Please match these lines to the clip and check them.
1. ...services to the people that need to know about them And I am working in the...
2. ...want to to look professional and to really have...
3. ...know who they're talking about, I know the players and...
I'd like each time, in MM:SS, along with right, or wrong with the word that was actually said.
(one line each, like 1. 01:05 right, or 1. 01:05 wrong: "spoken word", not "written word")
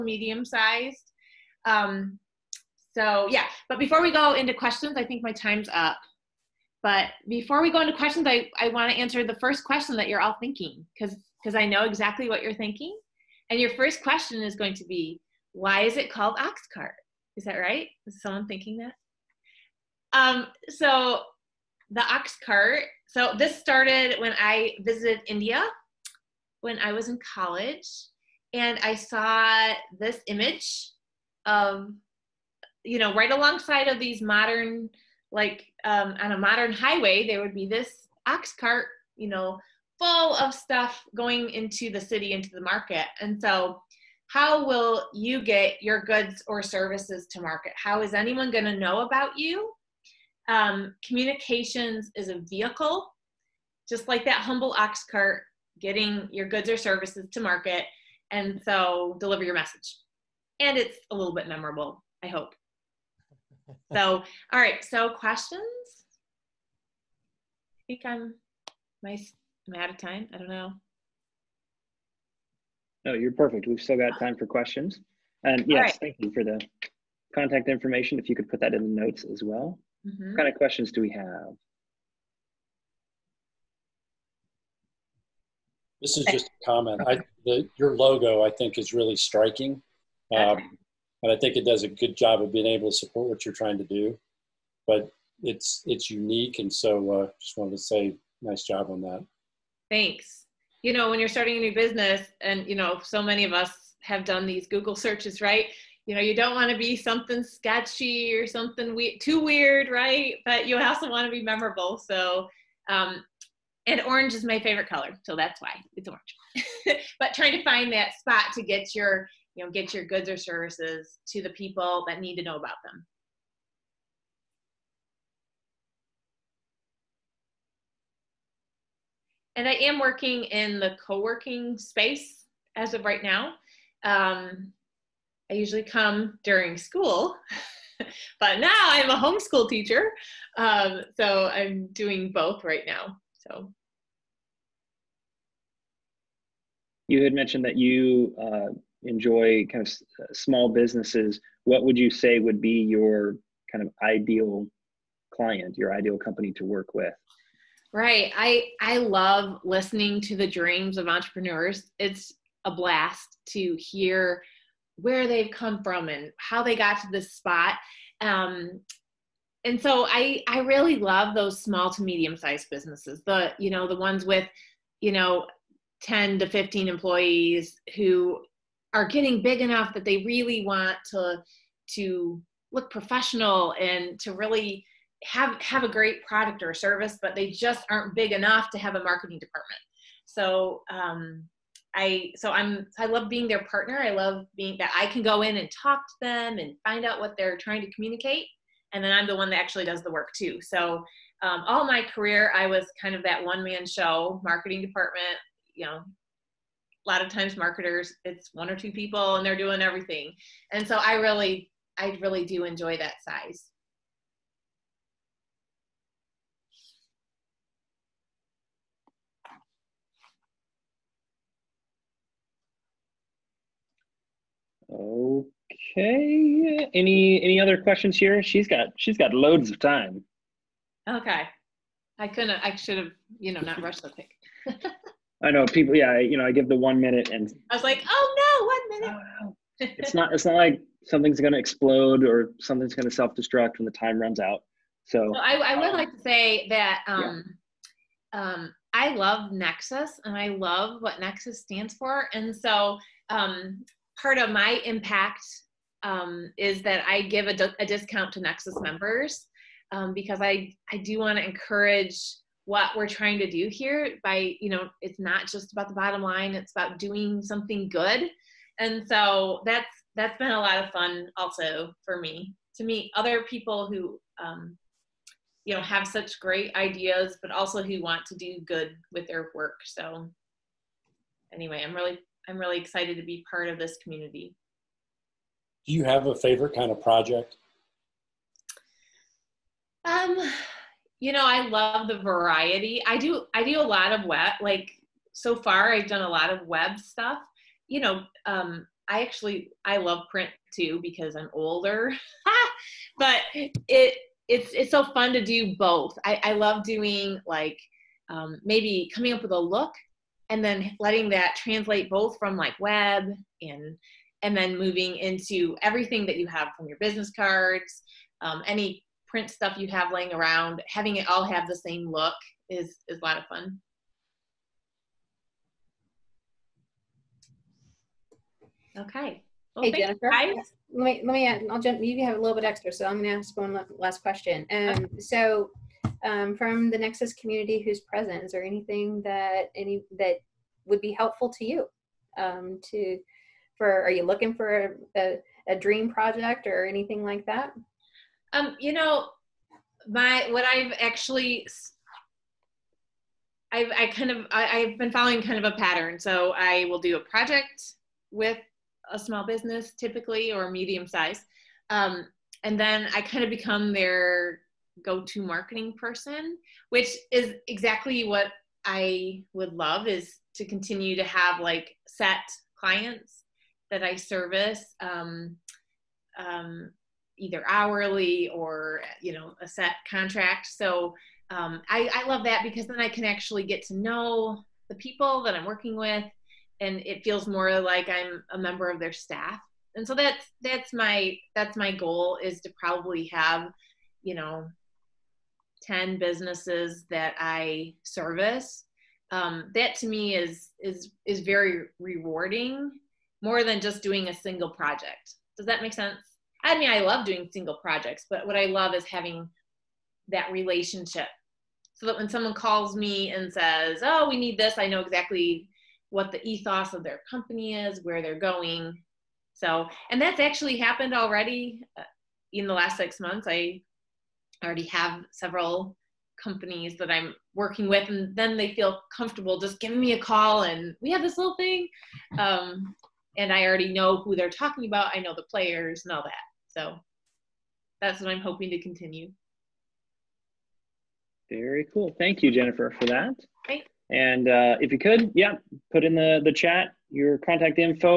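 1. 02:00 right
2. 03:00 right
3. 07:13 right.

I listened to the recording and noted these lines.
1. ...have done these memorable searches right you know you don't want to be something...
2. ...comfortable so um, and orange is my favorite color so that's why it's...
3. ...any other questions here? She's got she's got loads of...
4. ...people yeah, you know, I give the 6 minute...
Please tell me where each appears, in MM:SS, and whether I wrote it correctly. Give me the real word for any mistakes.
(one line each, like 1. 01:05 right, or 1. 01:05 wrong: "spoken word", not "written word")
1. 01:44 wrong: "google", not "memorable"
2. 01:51 wrong: "memorable", not "comfortable"
3. 03:47 right
4. 03:55 wrong: "1", not "6".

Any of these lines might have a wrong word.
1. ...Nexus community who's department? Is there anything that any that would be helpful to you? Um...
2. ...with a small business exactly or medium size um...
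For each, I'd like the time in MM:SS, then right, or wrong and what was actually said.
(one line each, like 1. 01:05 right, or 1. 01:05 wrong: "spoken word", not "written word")
1. 05:36 wrong: "present", not "department"
2. 05:58 wrong: "typically", not "exactly".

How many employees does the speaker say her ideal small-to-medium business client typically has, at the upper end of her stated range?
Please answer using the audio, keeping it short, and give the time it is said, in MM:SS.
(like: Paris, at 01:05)
15, at 02:56.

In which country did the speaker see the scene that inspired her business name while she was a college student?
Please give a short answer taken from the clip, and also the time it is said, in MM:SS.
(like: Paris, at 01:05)
India, at 00:25.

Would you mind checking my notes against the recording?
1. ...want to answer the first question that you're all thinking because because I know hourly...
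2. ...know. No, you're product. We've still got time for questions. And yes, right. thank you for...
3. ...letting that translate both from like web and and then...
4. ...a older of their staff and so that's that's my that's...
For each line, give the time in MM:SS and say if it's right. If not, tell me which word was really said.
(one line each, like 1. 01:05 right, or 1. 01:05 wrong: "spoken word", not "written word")
1. 00:08 wrong: "exactly", not "hourly"
2. 01:10 wrong: "perfect", not "product"
3. 05:10 right
4. 06:28 wrong: "member", not "older".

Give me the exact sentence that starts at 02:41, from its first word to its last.
It's a blast to hear where they've come from and how they got to this spot.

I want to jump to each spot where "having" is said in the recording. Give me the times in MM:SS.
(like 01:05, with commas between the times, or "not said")
05:20, 06:49.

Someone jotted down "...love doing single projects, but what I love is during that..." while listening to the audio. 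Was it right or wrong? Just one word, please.
wrong.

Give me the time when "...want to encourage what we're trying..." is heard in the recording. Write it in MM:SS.
04:21.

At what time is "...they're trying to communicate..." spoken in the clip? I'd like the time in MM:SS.
03:17.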